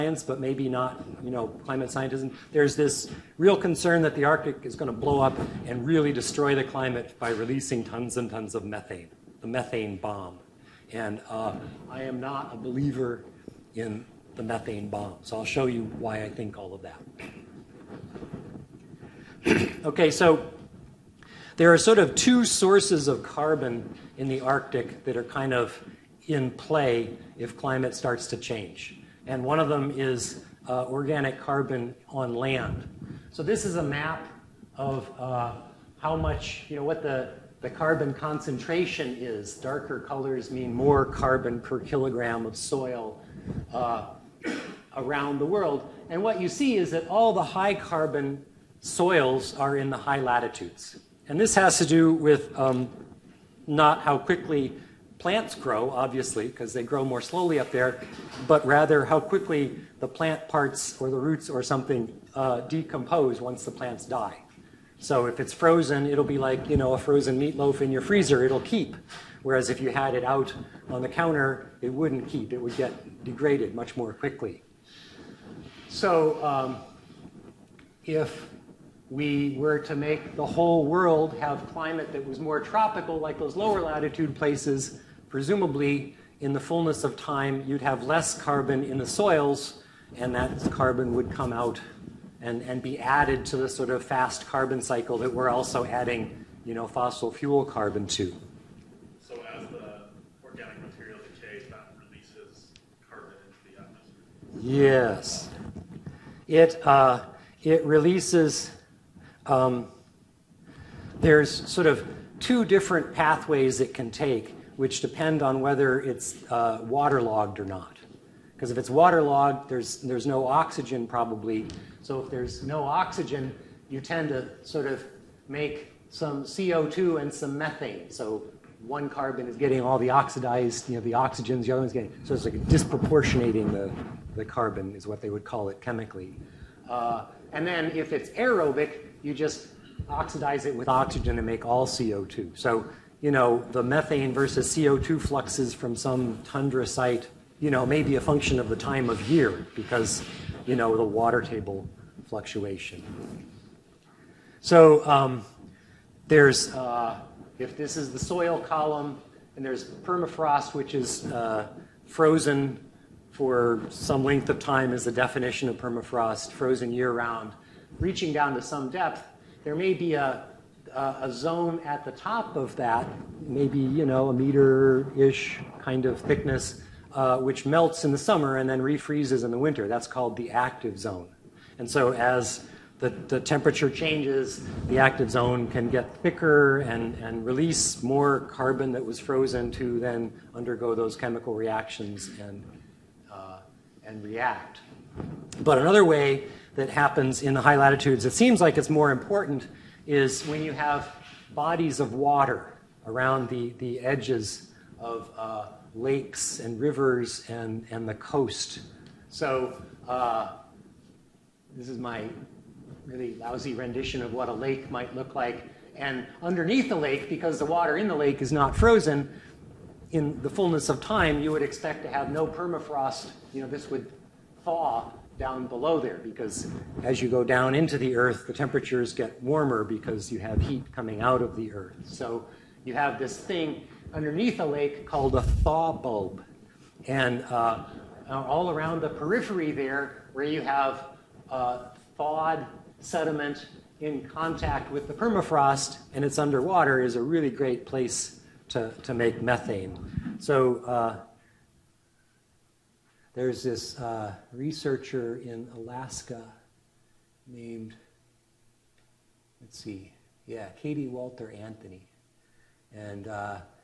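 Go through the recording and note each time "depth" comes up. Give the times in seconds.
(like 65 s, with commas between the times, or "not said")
168 s.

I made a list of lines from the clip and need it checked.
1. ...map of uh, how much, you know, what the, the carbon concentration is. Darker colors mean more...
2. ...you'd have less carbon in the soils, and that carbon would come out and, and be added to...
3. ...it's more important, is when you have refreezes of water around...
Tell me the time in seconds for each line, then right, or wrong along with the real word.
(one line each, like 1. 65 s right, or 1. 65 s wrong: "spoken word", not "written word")
1. 33 s right
2. 87 s right
3. 198 s wrong: "bodies", not "refreezes".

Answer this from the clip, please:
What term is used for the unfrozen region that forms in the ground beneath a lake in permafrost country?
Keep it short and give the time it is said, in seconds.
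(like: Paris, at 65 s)
Thaw bulb, at 235 s.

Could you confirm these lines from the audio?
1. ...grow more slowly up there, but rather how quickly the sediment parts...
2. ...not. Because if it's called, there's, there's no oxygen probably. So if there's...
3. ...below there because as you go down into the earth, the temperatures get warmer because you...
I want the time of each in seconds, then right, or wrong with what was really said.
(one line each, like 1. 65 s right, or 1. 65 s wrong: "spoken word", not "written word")
1. 56 s wrong: "plant", not "sediment"
2. 117 s wrong: "waterlogged", not "called"
3. 225 s right.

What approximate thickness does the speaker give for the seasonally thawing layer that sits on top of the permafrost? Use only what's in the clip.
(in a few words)
About 1 meter.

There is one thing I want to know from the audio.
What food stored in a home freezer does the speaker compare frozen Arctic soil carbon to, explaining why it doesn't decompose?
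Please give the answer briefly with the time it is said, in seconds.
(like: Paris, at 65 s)
Frozen meatloaf, at 66 s.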